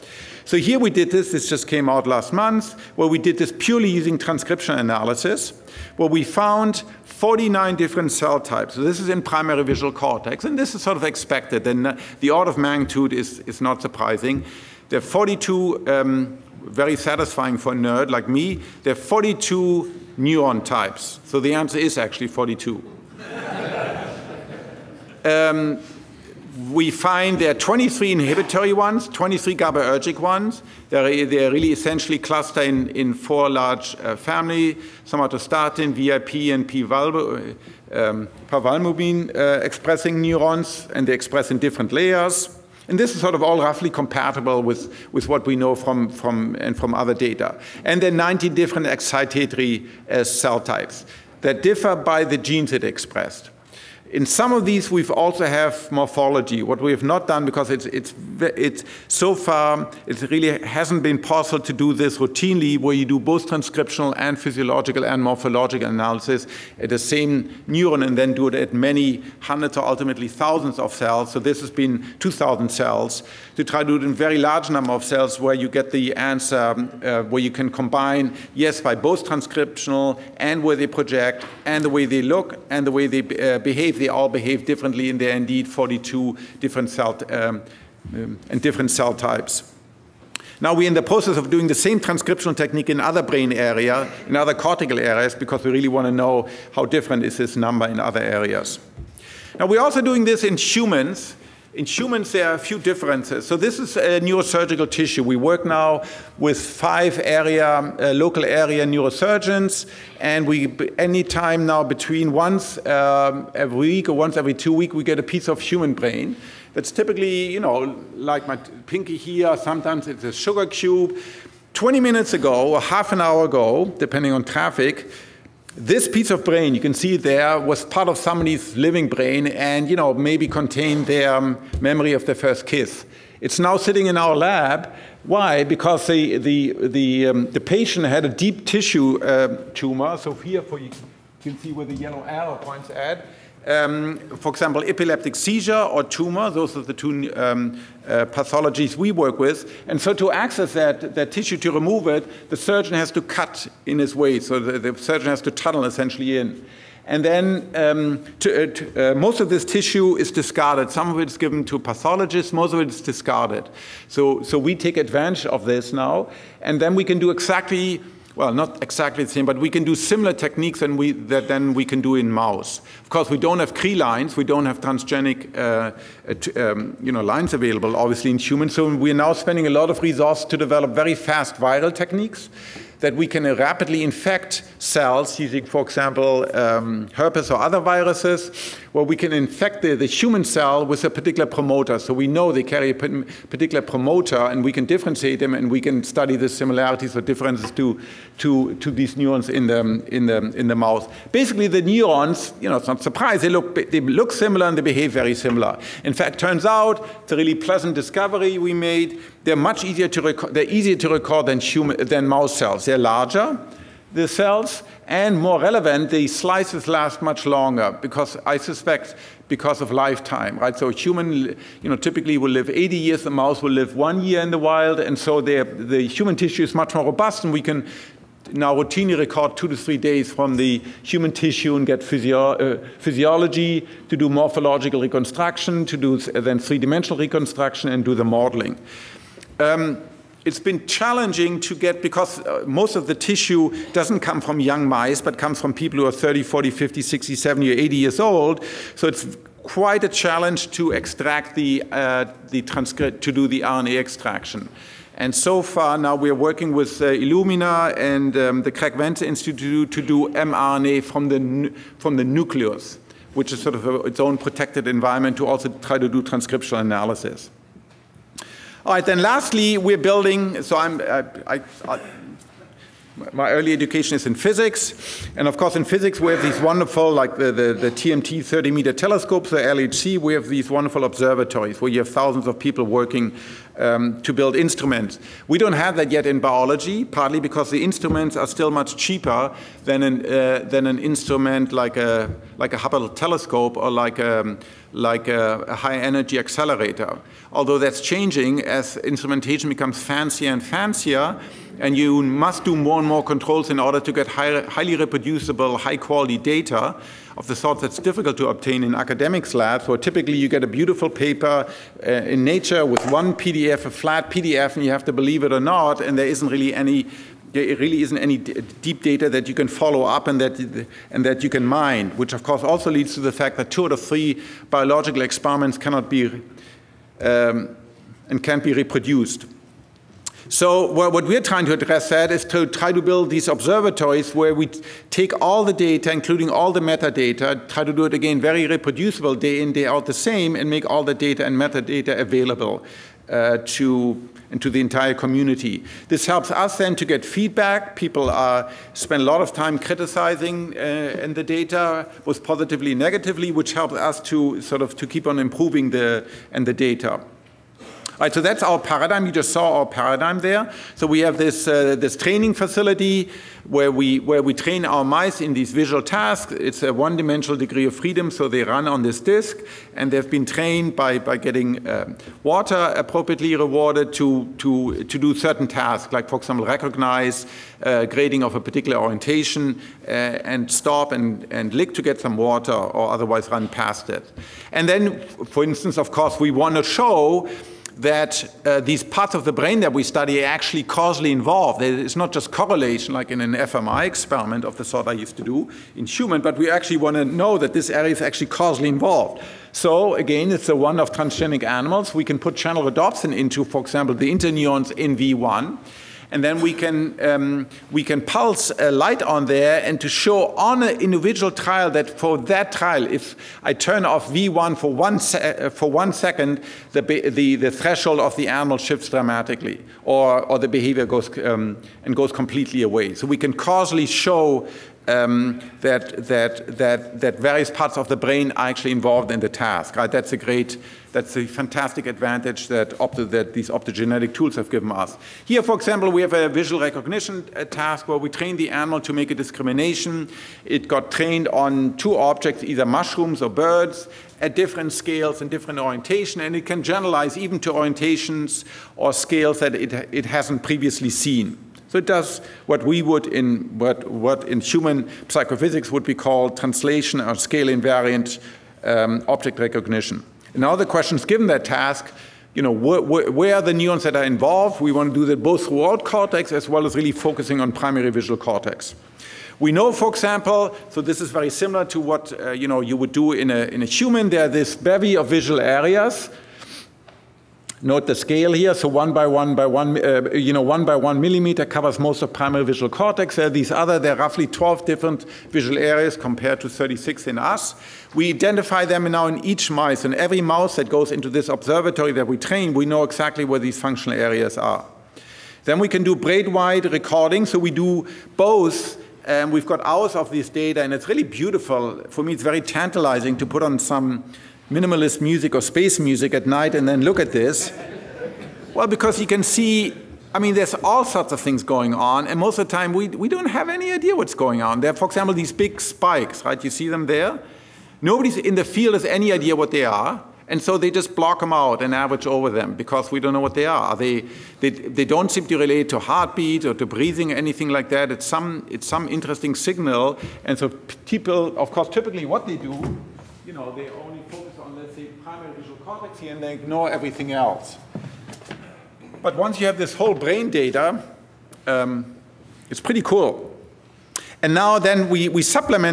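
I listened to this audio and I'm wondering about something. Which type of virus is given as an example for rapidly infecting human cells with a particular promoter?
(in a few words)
Herpes.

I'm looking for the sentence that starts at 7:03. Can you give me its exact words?
So we can causally show um, that, that, that, that various parts of the brain are actually involved in the task.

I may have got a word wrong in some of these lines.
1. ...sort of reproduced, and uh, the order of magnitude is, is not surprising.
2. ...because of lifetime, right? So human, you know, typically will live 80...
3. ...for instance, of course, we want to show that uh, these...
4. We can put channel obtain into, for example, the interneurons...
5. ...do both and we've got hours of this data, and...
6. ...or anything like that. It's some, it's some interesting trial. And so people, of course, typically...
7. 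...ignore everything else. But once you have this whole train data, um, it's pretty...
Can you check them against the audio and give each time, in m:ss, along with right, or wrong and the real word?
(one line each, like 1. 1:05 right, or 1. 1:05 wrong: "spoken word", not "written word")
1. 0:10 wrong: "expected", not "reproduced"
2. 3:39 right
3. 6:25 right
4. 6:42 wrong: "rhodopsin", not "obtain"
5. 8:17 right
6. 8:47 wrong: "signal", not "trial"
7. 8:56 wrong: "brain", not "train".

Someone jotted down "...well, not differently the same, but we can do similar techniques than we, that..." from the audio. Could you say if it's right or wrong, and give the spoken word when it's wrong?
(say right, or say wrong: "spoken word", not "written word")
wrong: "exactly", not "differently".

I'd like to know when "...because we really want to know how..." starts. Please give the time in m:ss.
1:35.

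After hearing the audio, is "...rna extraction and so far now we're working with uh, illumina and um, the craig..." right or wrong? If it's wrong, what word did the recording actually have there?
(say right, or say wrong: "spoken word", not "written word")
right.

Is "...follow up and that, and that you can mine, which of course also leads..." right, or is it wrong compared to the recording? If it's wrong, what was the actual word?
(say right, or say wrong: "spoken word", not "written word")
right.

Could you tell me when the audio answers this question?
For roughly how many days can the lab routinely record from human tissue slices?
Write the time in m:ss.
3:49.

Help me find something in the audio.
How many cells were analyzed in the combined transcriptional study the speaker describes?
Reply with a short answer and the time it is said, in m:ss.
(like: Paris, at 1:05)
2,000, at 1:12.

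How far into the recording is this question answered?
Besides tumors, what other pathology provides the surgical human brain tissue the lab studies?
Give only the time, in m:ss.
2:24.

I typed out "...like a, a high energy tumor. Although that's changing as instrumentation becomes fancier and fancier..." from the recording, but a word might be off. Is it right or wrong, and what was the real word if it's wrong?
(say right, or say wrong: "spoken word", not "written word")
wrong: "accelerator", not "tumor".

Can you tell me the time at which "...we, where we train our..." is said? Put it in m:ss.
6:03.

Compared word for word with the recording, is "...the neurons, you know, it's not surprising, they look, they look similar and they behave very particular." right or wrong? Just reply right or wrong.
wrong.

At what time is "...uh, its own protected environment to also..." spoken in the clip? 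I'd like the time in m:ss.
4:24.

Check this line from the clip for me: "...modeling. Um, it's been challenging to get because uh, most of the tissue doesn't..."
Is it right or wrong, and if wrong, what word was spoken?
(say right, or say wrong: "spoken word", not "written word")
right.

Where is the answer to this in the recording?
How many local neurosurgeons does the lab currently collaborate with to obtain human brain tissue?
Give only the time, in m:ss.
1:46.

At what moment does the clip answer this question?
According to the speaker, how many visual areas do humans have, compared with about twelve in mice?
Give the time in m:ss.
8:06.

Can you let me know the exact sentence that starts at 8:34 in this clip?
There are, for example, these big spikes, right?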